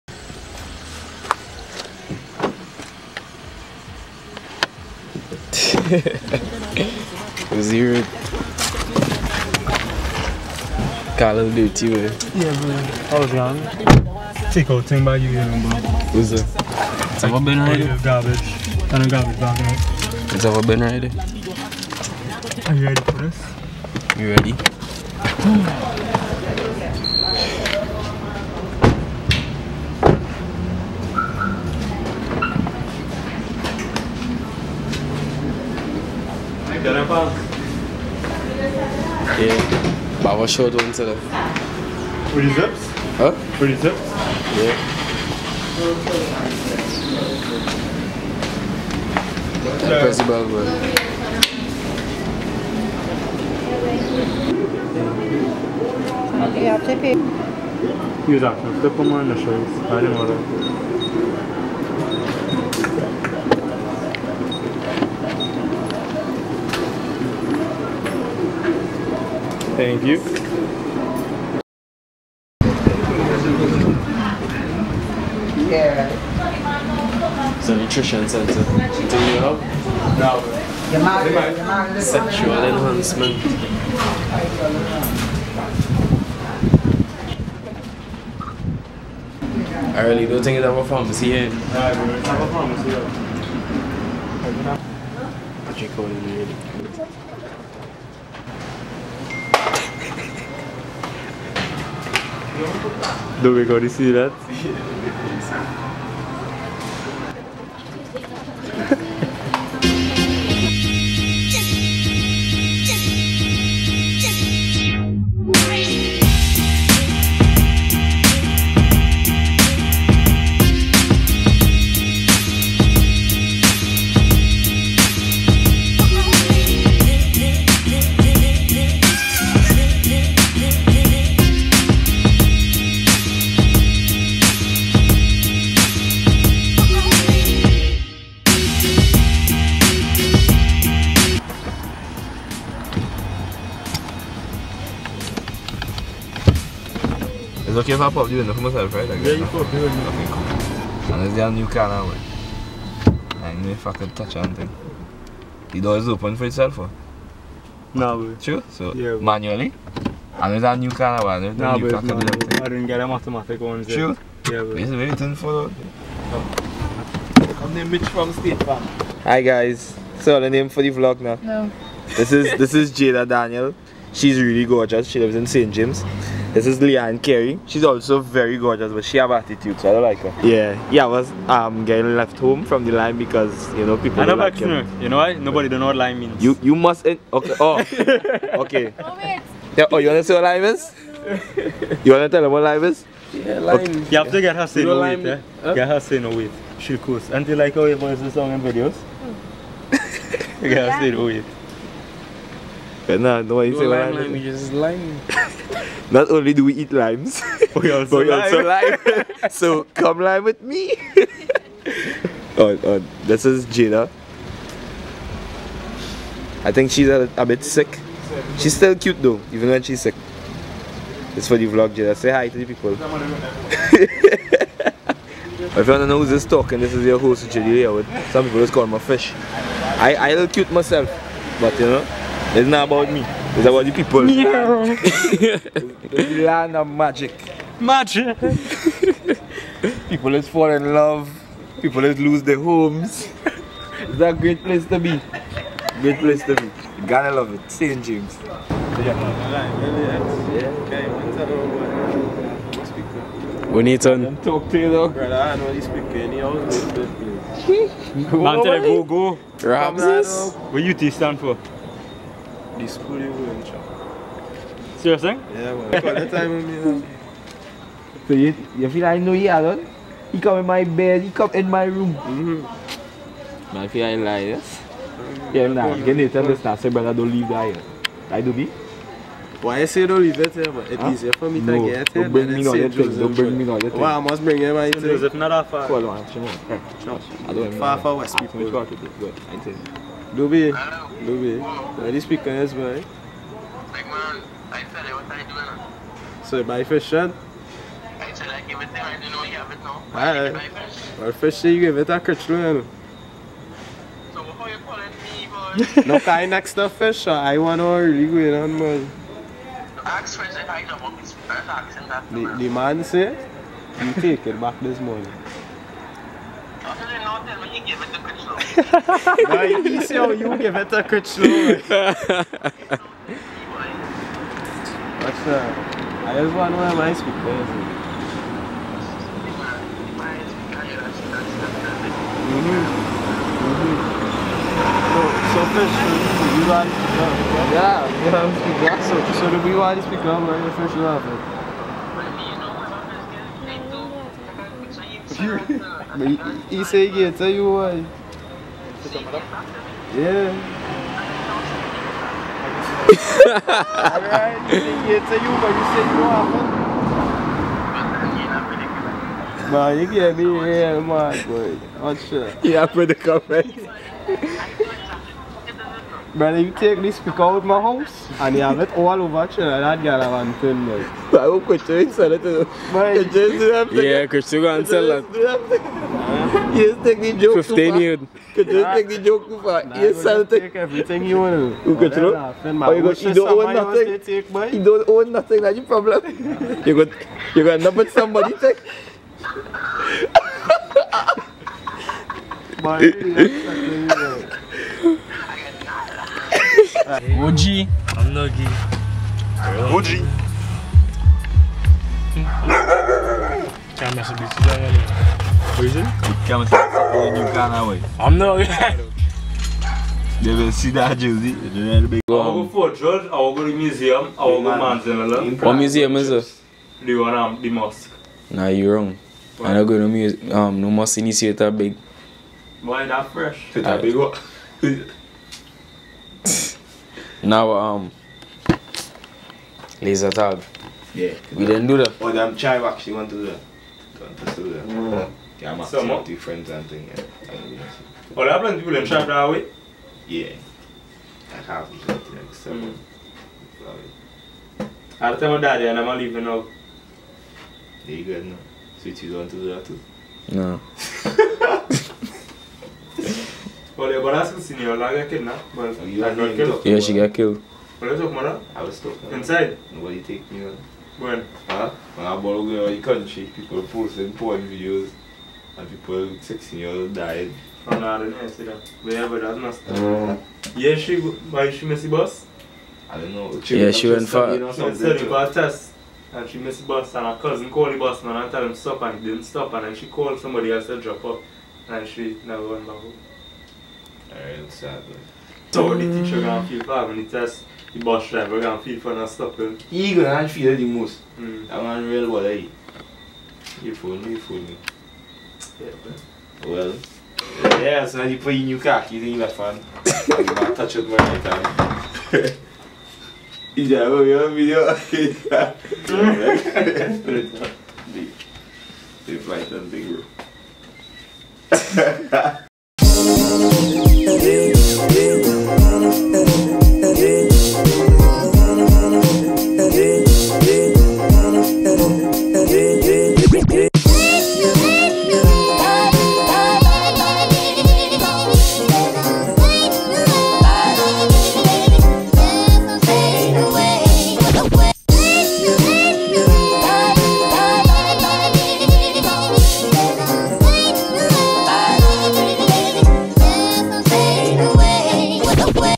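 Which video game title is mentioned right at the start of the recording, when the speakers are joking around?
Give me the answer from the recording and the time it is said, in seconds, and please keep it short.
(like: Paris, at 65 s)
Call of Duty, at 11 s.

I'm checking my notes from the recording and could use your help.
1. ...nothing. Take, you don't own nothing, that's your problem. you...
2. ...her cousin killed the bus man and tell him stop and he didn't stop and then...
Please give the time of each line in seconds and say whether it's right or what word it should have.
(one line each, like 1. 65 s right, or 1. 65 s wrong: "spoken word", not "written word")
1. 383 s right
2. 477 s wrong: "called", not "killed".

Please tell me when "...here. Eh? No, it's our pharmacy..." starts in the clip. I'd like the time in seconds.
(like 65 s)
91 s.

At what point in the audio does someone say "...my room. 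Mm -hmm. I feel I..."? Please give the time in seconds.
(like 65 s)
271 s.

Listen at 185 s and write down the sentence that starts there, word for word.
Nobody don't know what line means.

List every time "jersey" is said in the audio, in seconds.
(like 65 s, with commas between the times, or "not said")
411 s.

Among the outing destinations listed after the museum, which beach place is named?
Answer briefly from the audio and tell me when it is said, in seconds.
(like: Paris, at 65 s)
Manzanilla, at 414 s.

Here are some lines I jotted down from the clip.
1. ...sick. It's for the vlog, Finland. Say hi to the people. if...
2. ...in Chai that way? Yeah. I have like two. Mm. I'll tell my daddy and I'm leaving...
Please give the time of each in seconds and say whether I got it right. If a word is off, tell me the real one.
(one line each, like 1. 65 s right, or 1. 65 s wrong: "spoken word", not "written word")
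1. 220 s wrong: "Jada", not "Finland"
2. 438 s wrong: "seven", not "two".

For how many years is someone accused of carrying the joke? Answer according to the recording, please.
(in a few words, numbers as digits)
15.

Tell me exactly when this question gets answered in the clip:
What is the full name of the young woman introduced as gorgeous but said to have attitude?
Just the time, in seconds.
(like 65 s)
176 s.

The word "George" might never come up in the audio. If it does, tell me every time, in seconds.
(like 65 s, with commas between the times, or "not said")
412 s.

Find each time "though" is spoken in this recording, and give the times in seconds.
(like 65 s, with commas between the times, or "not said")
219 s, 254 s.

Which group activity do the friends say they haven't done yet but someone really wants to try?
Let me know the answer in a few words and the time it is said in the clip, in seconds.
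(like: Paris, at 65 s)
laser tag, at 430 s.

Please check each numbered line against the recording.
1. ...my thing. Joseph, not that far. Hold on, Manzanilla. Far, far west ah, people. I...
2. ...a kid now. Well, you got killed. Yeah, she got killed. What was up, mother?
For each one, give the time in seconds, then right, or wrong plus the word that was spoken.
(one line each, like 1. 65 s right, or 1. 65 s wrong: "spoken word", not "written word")
1. 284 s wrong: "Shimon", not "Manzanilla"
2. 455 s right.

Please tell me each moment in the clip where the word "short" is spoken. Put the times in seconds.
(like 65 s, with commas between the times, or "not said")
40 s.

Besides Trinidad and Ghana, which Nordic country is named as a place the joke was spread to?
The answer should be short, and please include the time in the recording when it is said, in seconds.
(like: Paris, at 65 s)
Finland, at 370 s.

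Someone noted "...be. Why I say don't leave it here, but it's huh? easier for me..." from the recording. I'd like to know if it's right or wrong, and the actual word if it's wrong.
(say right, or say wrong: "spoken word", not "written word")
right.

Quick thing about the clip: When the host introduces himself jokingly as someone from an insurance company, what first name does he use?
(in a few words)
Mitch.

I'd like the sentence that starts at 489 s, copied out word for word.
He gonna feel it the most.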